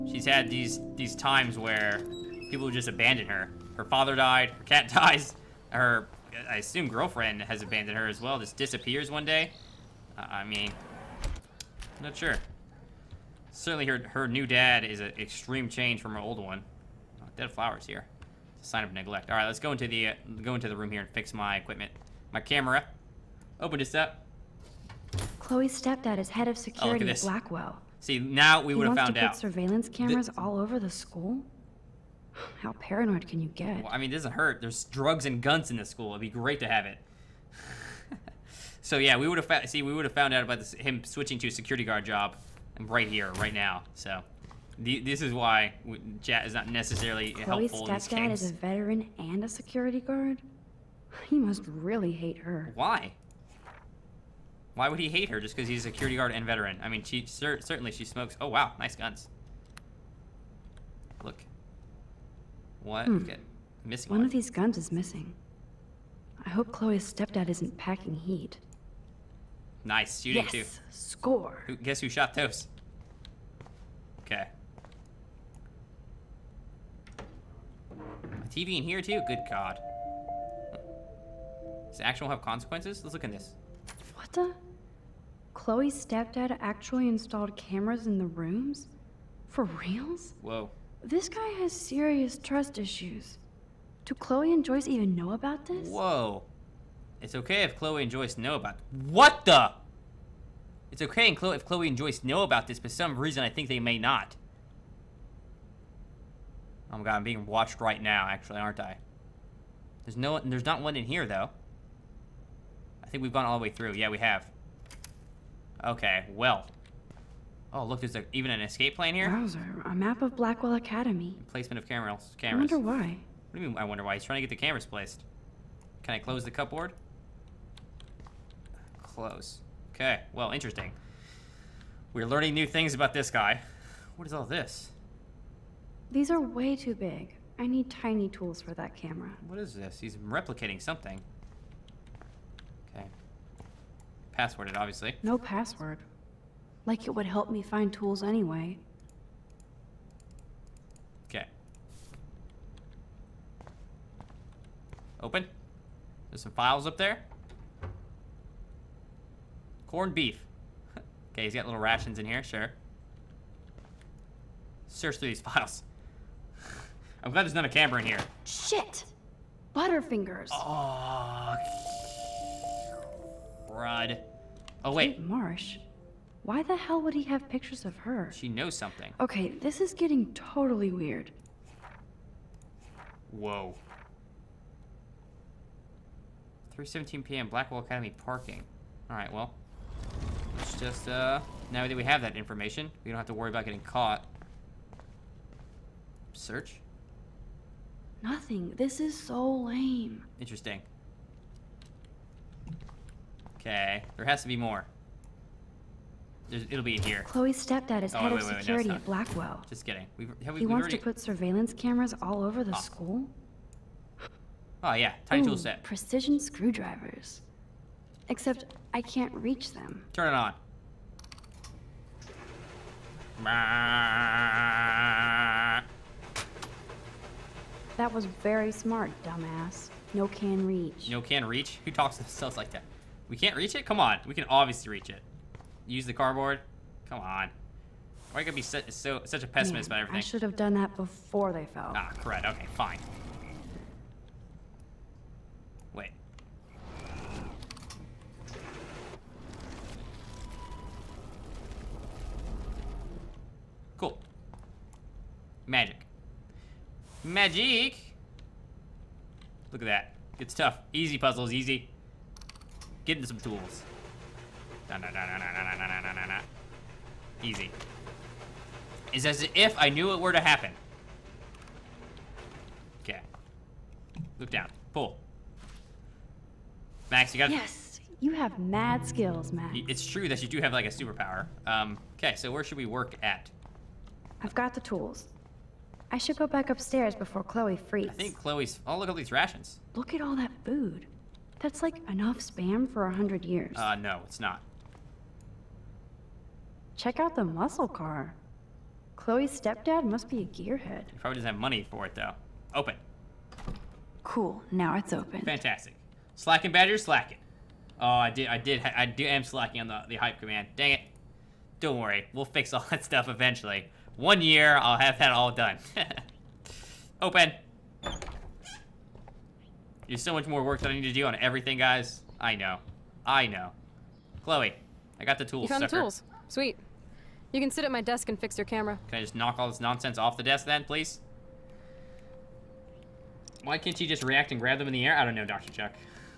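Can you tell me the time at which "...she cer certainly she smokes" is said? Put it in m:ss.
0:57.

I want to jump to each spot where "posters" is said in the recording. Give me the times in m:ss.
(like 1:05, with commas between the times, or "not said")
not said.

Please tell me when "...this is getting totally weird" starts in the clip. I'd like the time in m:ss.
2:59.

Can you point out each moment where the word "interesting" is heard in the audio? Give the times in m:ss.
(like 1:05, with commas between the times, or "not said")
2:10, 3:20.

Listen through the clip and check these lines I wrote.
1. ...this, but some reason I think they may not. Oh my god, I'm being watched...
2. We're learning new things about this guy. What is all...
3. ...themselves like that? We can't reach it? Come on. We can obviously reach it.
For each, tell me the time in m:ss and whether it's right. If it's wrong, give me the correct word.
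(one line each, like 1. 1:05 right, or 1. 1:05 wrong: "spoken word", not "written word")
1. 1:42 right
2. 2:12 right
3. 3:52 right.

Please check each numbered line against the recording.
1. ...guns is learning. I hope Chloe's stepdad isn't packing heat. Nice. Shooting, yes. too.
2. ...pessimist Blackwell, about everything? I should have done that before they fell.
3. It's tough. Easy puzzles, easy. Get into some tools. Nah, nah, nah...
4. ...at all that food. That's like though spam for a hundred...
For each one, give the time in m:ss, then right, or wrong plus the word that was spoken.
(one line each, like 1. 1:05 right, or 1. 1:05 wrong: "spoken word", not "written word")
1. 1:04 wrong: "missing", not "learning"
2. 3:59 wrong: "Man", not "Blackwell"
3. 4:20 right
4. 4:50 wrong: "enough", not "though".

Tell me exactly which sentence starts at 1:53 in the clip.
I think we've gone all the way through.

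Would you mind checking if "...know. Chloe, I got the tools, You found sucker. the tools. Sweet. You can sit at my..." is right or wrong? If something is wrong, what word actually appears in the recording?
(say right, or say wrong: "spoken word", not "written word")
right.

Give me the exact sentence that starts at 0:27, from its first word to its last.
See, now we would have found to put out.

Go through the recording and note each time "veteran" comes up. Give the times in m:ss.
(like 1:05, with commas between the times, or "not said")
0:48, 0:56.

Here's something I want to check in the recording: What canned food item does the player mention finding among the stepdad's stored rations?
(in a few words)
Corned beef.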